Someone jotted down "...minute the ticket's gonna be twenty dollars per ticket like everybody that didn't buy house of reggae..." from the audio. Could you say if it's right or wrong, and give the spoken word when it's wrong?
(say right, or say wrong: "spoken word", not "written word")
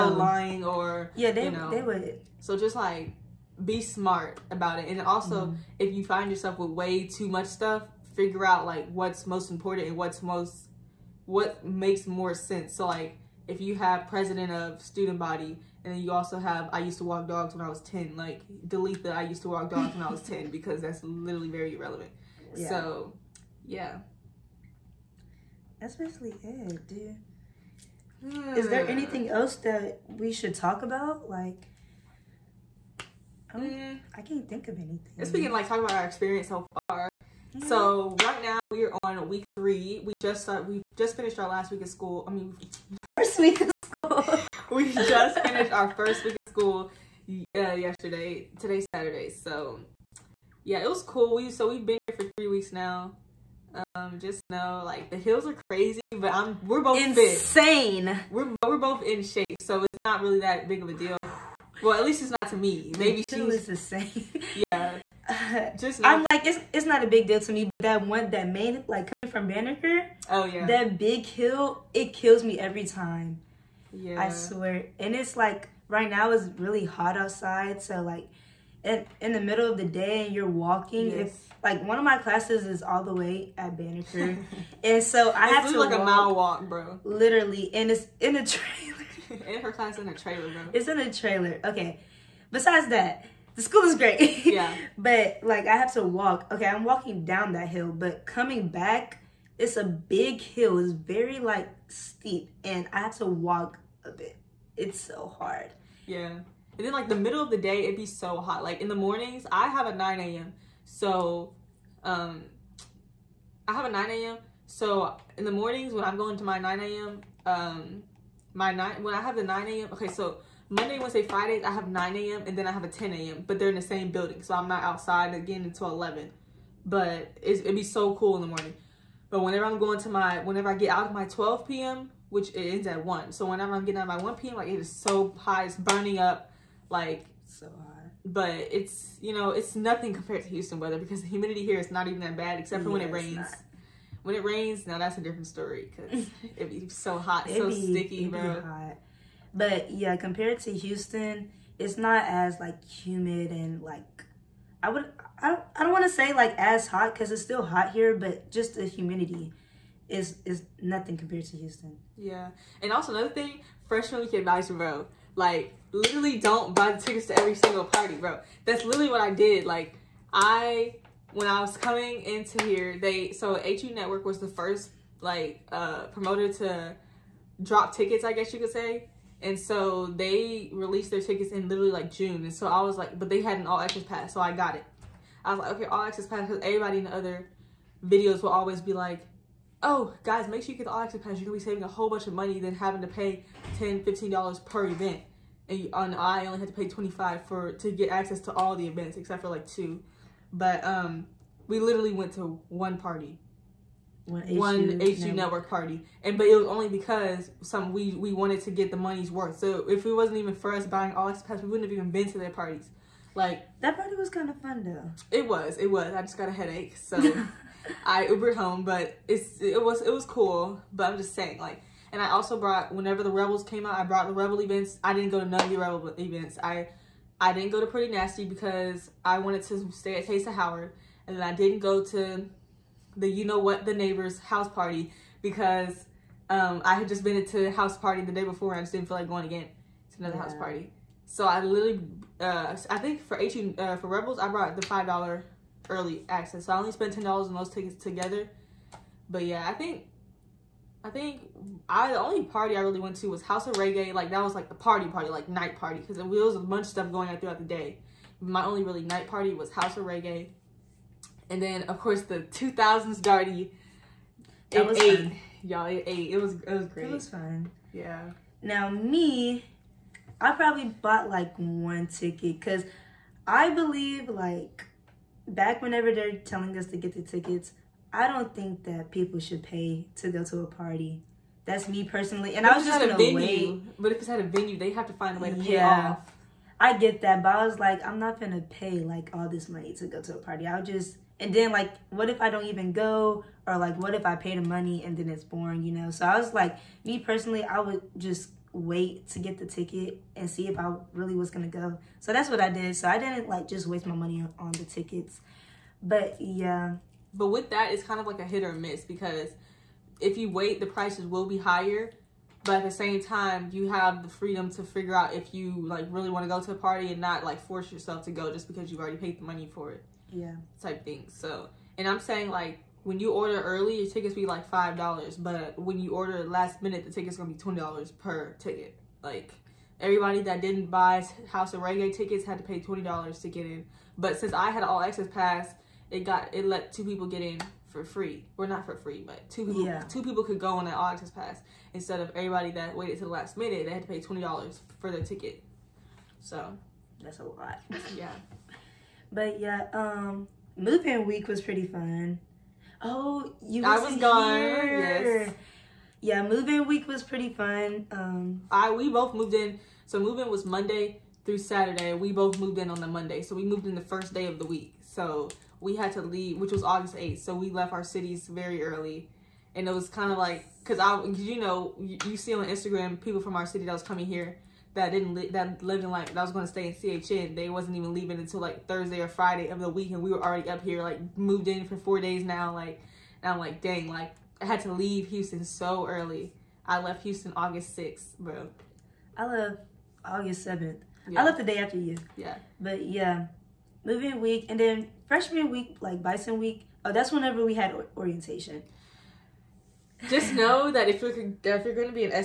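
right.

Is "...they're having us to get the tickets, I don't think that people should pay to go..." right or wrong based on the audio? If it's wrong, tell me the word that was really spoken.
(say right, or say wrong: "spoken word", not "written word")
wrong: "telling", not "having".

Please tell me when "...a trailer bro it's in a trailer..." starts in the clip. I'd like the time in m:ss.
1:30.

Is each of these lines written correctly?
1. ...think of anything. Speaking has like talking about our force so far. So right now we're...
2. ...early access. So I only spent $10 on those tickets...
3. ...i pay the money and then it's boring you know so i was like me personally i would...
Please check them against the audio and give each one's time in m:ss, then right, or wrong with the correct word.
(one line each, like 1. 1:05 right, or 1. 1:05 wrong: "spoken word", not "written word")
1. 0:34 wrong: "experience", not "force"
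2. 4:05 right
3. 4:54 right.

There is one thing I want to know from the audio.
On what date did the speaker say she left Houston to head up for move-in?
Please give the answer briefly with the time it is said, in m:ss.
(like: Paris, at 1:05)
August 6, at 6:27.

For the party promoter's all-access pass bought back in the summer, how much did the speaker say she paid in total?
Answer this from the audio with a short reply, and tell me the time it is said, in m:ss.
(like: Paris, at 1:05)
$25, at 3:16.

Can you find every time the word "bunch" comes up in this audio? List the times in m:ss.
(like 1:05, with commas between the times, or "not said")
3:12, 4:16.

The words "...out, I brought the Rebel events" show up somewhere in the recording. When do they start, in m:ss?
3:43.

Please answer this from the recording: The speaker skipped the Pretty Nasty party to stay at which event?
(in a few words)
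Taste of Howard.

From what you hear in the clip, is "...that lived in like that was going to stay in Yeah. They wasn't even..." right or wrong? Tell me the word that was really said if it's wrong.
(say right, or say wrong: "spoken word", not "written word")
wrong: "CHN", not "Yeah".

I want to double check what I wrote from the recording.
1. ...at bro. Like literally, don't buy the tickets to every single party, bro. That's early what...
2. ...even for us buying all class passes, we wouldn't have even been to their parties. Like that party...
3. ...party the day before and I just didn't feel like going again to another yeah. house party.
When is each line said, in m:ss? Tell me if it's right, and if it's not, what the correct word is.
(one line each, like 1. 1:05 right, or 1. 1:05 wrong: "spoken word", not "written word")
1. 2:44 wrong: "literally", not "early"
2. 3:30 wrong: "access", not "class"
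3. 3:57 right.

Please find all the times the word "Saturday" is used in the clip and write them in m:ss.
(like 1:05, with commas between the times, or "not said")
0:48, 6:01.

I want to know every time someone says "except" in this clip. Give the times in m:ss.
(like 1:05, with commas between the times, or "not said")
2:22, 3:19.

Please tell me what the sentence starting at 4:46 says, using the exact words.
I get that, but I was like, I'm not gonna pay like all this money to go to a party.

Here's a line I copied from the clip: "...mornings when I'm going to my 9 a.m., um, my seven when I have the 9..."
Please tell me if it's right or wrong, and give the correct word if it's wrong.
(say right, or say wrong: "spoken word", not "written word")
wrong: "nine", not "seven".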